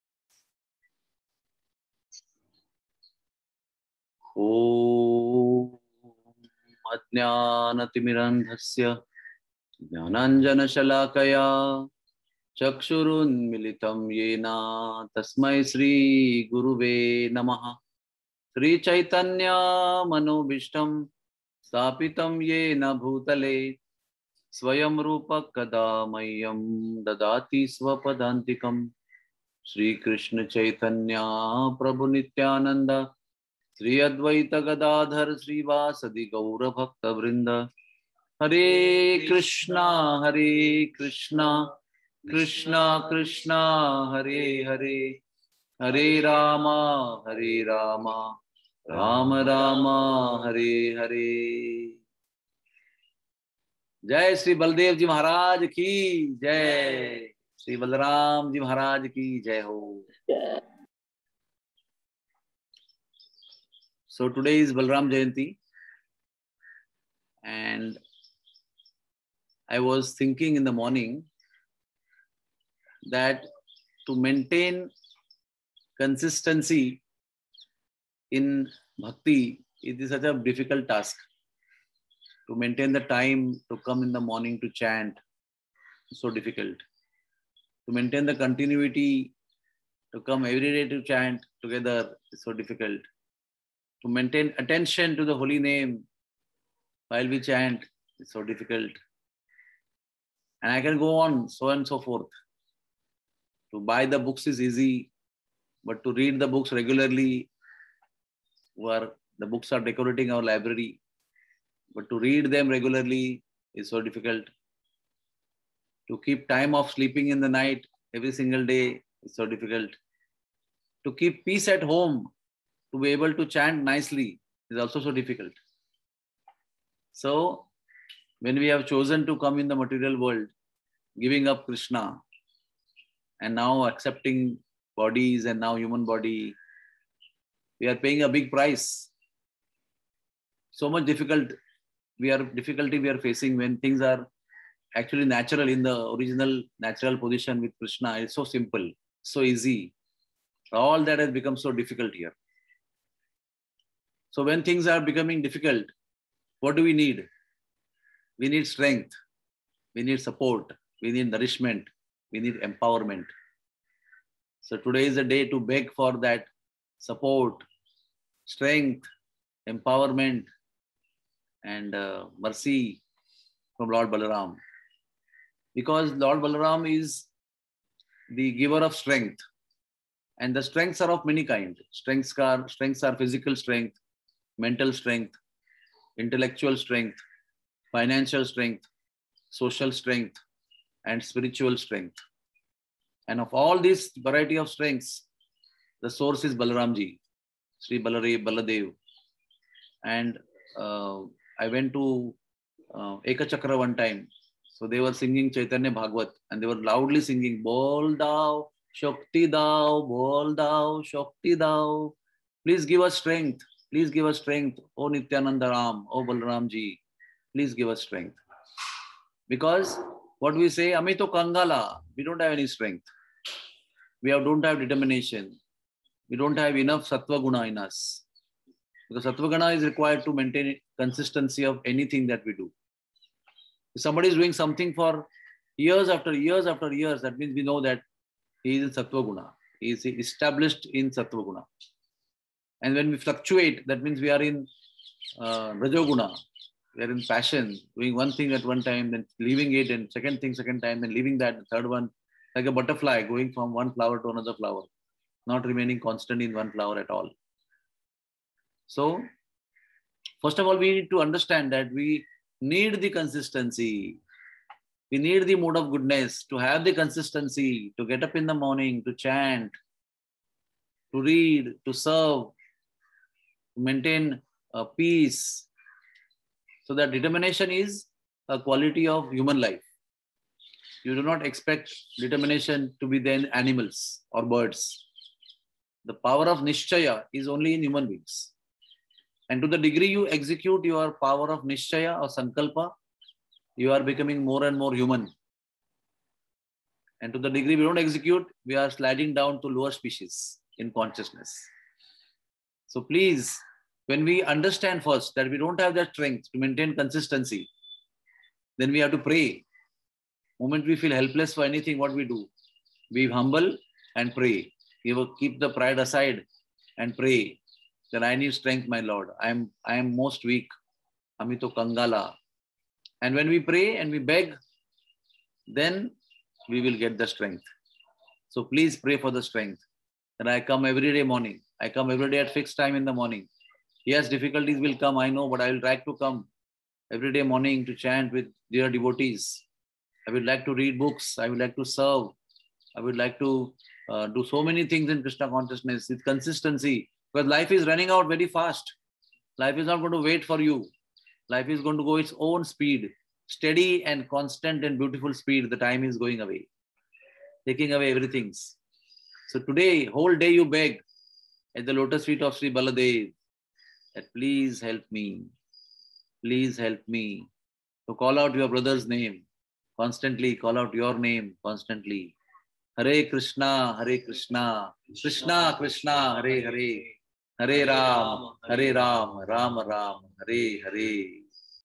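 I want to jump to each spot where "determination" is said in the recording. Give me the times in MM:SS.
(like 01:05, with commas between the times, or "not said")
03:44, 04:37, 04:42.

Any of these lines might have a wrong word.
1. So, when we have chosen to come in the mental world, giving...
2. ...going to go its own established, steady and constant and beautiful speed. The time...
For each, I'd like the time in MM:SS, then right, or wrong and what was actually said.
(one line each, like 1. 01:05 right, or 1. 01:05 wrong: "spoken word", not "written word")
1. 02:07 wrong: "material", not "mental"
2. 05:51 wrong: "speed", not "established".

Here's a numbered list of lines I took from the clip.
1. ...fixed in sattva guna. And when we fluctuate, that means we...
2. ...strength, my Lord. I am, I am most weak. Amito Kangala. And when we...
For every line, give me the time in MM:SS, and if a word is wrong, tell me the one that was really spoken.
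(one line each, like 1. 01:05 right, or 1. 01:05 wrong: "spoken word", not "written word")
1. 04:00 wrong: "established", not "fixed"
2. 05:18 right.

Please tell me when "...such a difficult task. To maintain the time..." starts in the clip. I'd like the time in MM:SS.
01:20.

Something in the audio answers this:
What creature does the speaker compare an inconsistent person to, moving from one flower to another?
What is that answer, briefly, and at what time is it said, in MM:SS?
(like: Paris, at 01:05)
a butterfly, at 04:12.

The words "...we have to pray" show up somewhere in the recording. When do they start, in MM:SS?
05:08.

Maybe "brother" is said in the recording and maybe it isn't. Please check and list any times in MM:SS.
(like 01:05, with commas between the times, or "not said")
06:08.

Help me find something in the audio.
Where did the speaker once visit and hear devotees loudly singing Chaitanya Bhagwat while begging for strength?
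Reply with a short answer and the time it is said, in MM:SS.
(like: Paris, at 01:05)
Eka Chakra, at 03:23.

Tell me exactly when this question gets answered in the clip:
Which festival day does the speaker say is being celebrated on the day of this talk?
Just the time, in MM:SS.
01:04.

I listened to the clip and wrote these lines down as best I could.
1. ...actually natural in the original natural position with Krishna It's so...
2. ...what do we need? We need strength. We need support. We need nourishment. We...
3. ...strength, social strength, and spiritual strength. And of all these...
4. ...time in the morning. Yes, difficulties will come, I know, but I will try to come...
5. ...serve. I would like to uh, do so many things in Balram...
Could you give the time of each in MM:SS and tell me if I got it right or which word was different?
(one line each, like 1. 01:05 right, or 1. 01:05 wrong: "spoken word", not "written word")
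1. 02:24 right
2. 02:36 right
3. 03:08 right
4. 05:32 right
5. 05:41 wrong: "Krishna", not "Balram".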